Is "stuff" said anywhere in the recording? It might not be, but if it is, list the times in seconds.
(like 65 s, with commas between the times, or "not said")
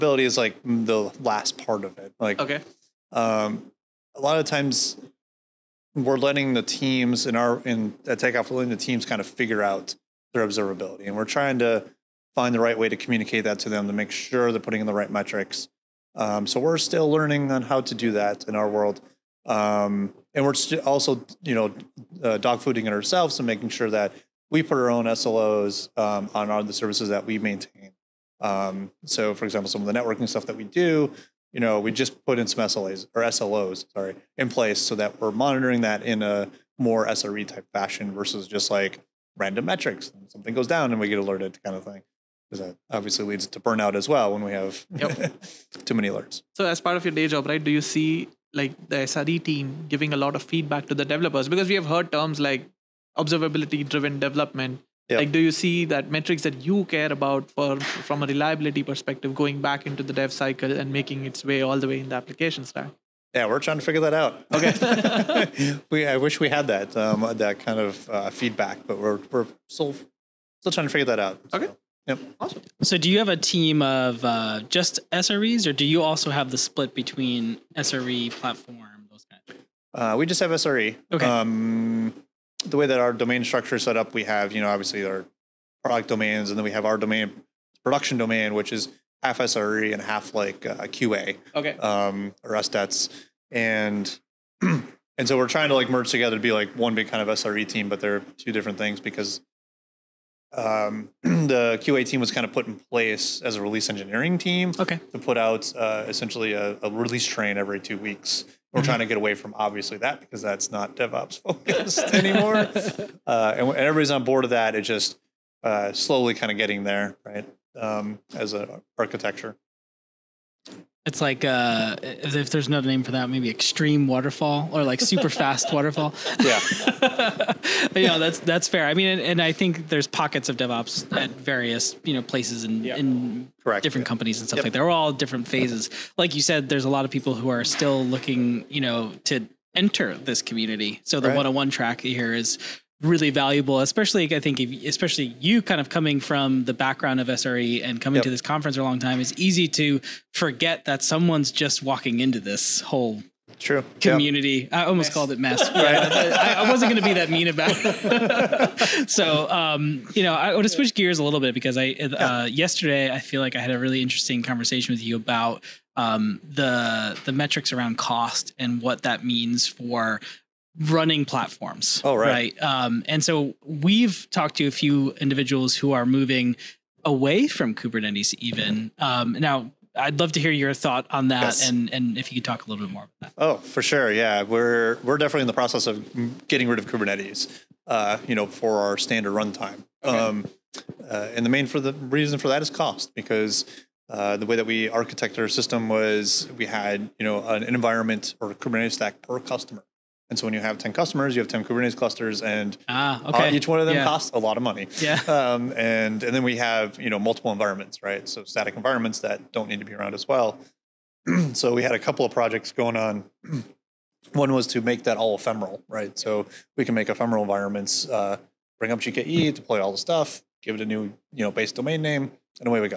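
30 s, 134 s, 219 s.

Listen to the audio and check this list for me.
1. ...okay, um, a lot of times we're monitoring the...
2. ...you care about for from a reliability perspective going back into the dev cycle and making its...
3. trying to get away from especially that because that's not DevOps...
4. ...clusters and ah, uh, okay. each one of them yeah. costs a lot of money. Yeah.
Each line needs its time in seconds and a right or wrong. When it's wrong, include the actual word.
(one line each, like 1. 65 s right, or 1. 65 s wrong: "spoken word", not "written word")
1. 2 s wrong: "letting", not "monitoring"
2. 56 s right
3. 108 s wrong: "obviously", not "especially"
4. 201 s right.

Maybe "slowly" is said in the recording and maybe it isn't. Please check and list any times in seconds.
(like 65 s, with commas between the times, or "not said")
115 s.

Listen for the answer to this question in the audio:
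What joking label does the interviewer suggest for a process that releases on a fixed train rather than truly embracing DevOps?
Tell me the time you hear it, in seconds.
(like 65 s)
123 s.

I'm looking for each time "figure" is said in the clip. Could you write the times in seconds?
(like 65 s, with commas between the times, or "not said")
9 s, 63 s, 70 s.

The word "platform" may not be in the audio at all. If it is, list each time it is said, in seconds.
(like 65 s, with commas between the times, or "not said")
78 s, 171 s.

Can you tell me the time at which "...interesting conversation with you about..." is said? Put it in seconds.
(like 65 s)
164 s.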